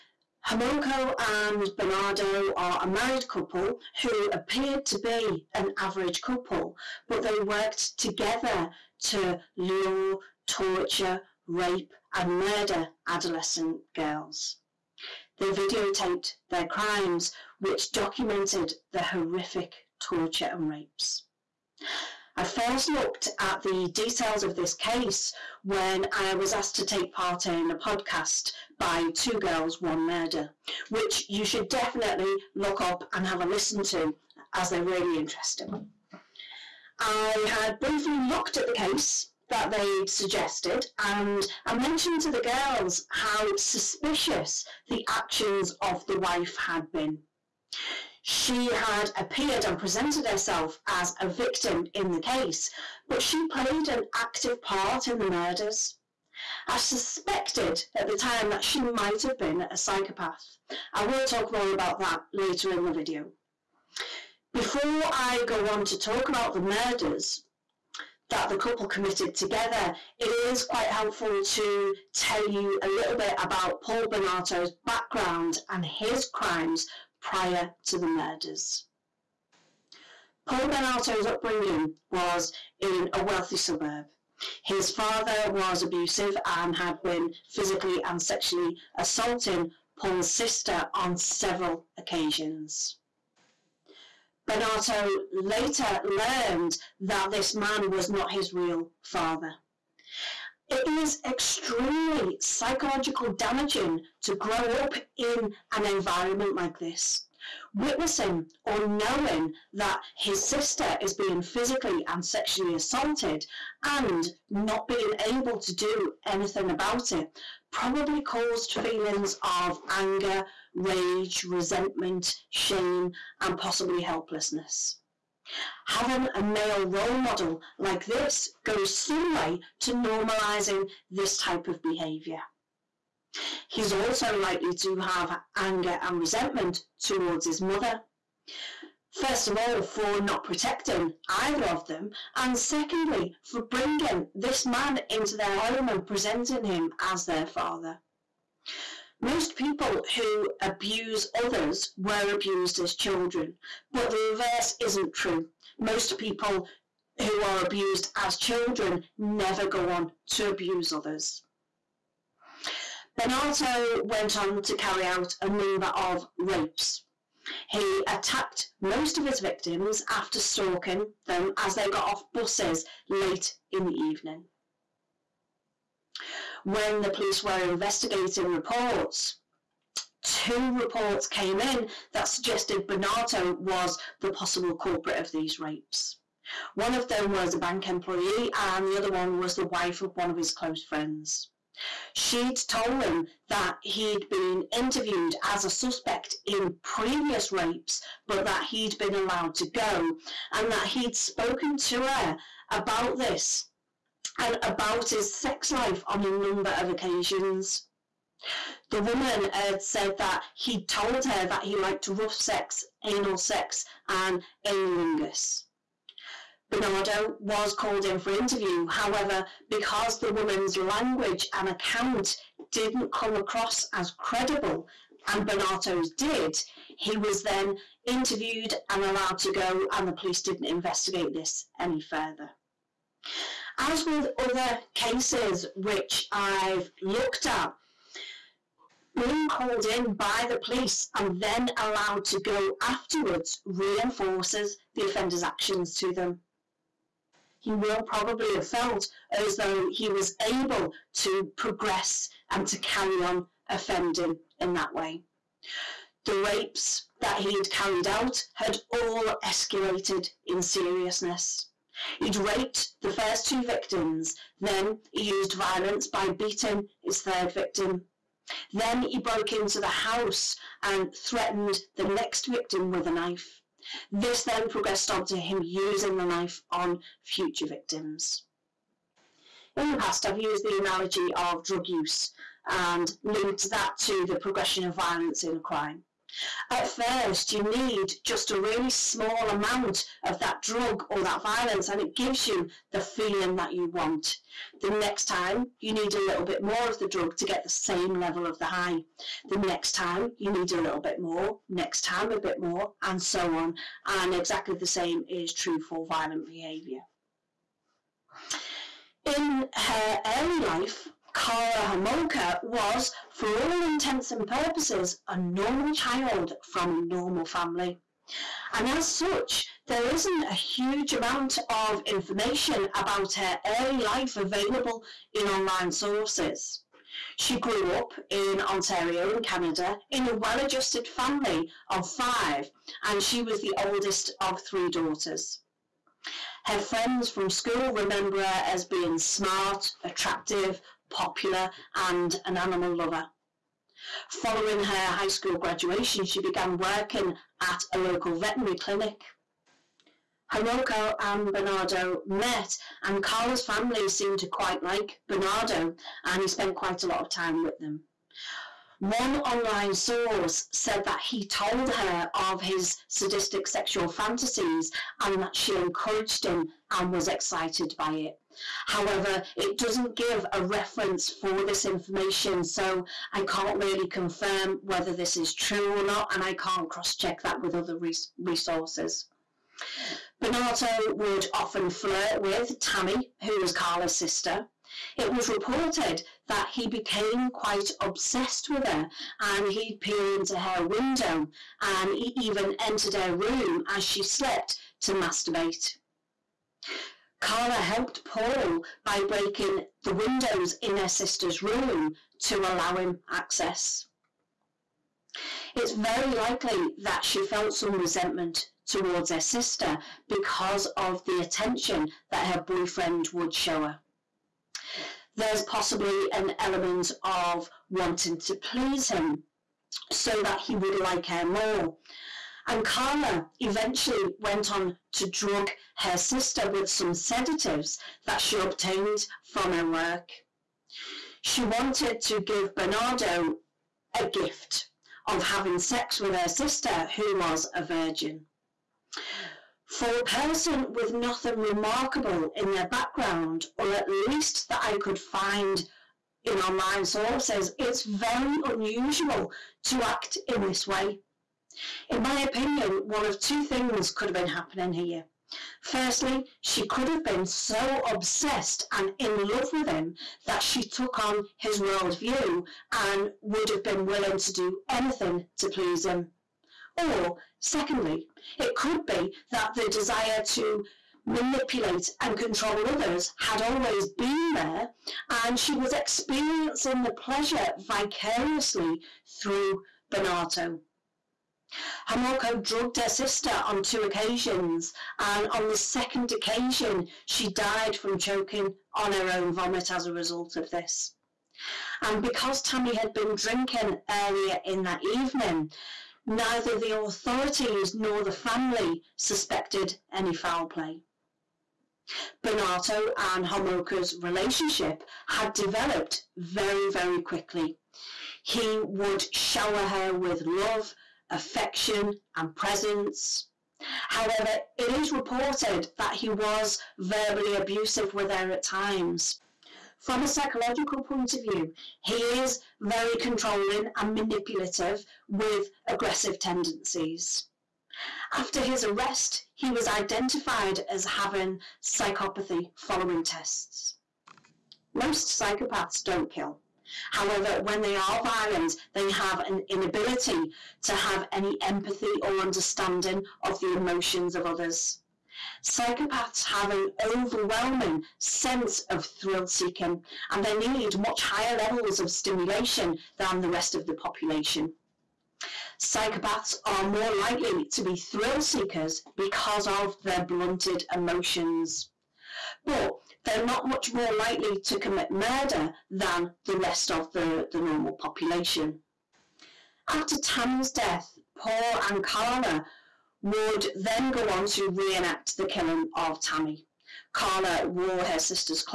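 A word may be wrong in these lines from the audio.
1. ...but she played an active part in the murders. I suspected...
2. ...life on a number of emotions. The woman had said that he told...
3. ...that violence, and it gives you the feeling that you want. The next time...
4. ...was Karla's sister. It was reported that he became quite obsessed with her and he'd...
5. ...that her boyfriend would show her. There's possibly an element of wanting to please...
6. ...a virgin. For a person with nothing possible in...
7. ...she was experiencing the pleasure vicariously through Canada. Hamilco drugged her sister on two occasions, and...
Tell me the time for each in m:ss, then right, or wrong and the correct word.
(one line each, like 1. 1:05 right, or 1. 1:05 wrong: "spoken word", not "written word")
1. 0:53 right
2. 3:25 wrong: "occasions", not "emotions"
3. 4:51 right
4. 6:23 right
5. 6:52 right
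6. 7:17 wrong: "remarkable", not "possible"
7. 7:55 wrong: "Bernardo", not "Canada".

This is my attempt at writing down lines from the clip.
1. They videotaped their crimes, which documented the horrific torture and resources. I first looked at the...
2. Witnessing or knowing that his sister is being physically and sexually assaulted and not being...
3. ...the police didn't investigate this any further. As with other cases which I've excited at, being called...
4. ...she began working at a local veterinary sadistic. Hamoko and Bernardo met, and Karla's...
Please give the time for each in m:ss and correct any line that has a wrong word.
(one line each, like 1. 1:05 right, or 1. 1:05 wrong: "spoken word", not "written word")
1. 0:15 wrong: "rapes", not "resources"
2. 1:47 right
3. 3:50 wrong: "looked", not "excited"
4. 5:46 wrong: "clinic", not "sadistic".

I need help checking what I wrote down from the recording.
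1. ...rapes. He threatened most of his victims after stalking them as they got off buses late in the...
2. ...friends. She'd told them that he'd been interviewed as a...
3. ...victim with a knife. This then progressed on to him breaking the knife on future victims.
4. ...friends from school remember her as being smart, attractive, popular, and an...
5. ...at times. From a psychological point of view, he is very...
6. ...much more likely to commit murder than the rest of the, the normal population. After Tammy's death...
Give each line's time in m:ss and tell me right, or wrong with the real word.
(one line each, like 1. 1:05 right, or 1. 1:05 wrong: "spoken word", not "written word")
1. 2:46 wrong: "attacked", not "threatened"
2. 3:10 right
3. 4:32 wrong: "using", not "breaking"
4. 5:36 right
5. 8:38 right
6. 9:23 right.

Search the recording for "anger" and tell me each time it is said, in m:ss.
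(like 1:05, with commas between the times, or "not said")
1:59, 2:15.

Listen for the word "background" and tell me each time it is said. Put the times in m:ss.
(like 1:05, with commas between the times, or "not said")
1:14, 7:22.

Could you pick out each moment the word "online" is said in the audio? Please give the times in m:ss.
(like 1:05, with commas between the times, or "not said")
5:25, 5:59, 7:26.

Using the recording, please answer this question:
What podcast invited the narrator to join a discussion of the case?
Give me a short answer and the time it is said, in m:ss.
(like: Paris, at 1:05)
Two Girls, One Murder, at 0:29.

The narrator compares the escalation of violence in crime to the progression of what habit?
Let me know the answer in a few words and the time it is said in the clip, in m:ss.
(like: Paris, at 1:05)
Drug use, at 4:41.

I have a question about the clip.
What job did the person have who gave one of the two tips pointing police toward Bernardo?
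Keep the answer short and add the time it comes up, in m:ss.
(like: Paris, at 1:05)
Bank employee, at 3:07.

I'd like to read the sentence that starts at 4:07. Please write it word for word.
He will probably have felt as though he was able to progress and to carry on offending in that way.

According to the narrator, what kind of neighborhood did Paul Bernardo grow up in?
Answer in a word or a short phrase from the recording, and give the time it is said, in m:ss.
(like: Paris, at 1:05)
A wealthy suburb, at 1:23.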